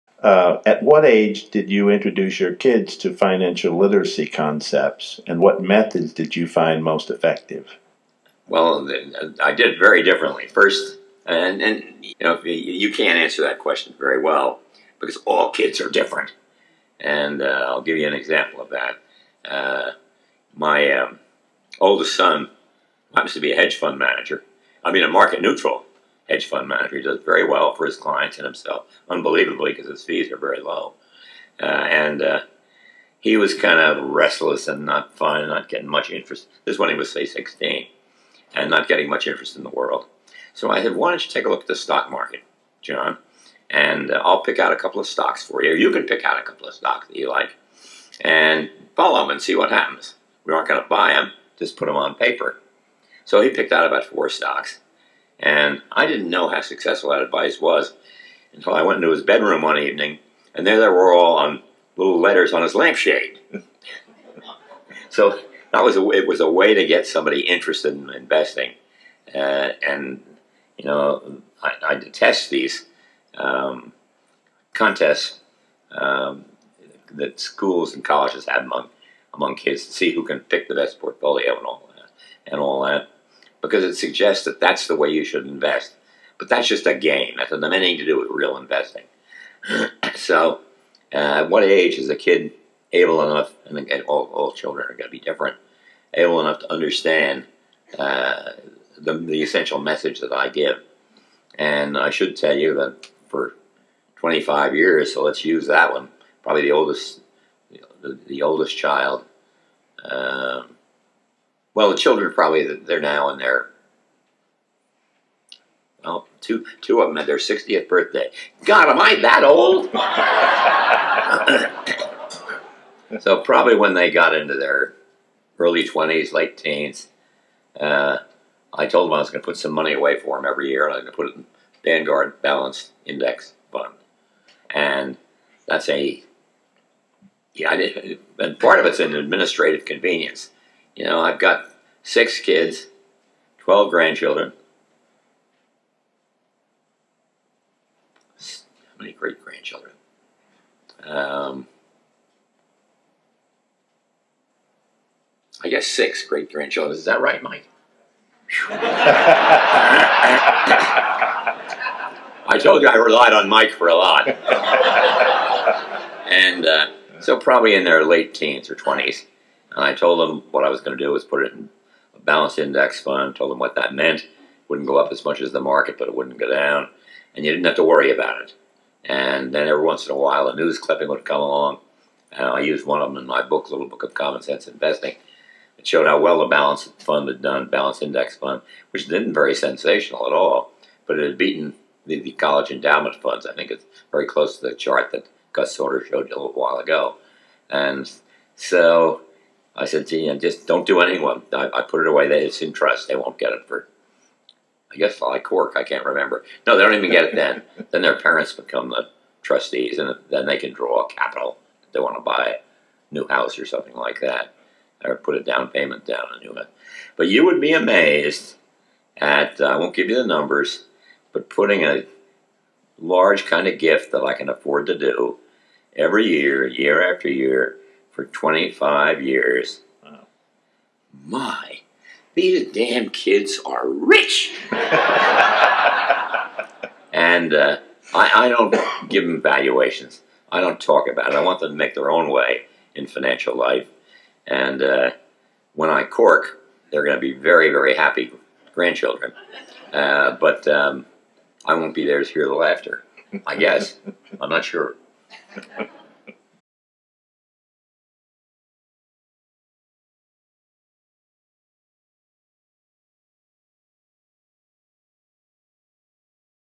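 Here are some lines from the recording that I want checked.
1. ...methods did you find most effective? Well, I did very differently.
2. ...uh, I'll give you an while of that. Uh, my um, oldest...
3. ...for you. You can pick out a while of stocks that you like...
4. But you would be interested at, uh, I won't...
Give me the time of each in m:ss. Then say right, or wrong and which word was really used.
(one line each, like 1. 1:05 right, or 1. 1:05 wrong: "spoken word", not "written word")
1. 0:05 right
2. 0:17 wrong: "example", not "while"
3. 0:45 wrong: "couple", not "while"
4. 3:37 wrong: "amazed", not "interested".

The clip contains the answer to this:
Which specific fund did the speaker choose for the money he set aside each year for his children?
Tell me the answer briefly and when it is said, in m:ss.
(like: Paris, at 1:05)
Vanguard Balanced Index Fund, at 2:11.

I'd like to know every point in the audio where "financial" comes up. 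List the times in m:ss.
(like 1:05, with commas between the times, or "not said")
0:03, 4:03.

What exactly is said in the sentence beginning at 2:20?
You know, I've got six kids, 12 grandchildren.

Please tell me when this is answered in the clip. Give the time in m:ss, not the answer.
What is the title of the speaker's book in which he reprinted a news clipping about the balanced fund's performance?
3:03.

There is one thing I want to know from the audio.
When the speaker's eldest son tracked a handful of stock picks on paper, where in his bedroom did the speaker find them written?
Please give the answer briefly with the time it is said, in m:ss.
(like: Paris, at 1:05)
On his lampshade, at 1:02.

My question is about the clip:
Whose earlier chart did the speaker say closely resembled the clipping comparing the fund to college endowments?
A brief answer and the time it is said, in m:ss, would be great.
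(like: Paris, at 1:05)
Gus Sauter, at 3:15.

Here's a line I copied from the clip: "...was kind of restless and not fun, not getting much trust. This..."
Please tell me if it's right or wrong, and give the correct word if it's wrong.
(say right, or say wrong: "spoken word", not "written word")
wrong: "interest", not "trust".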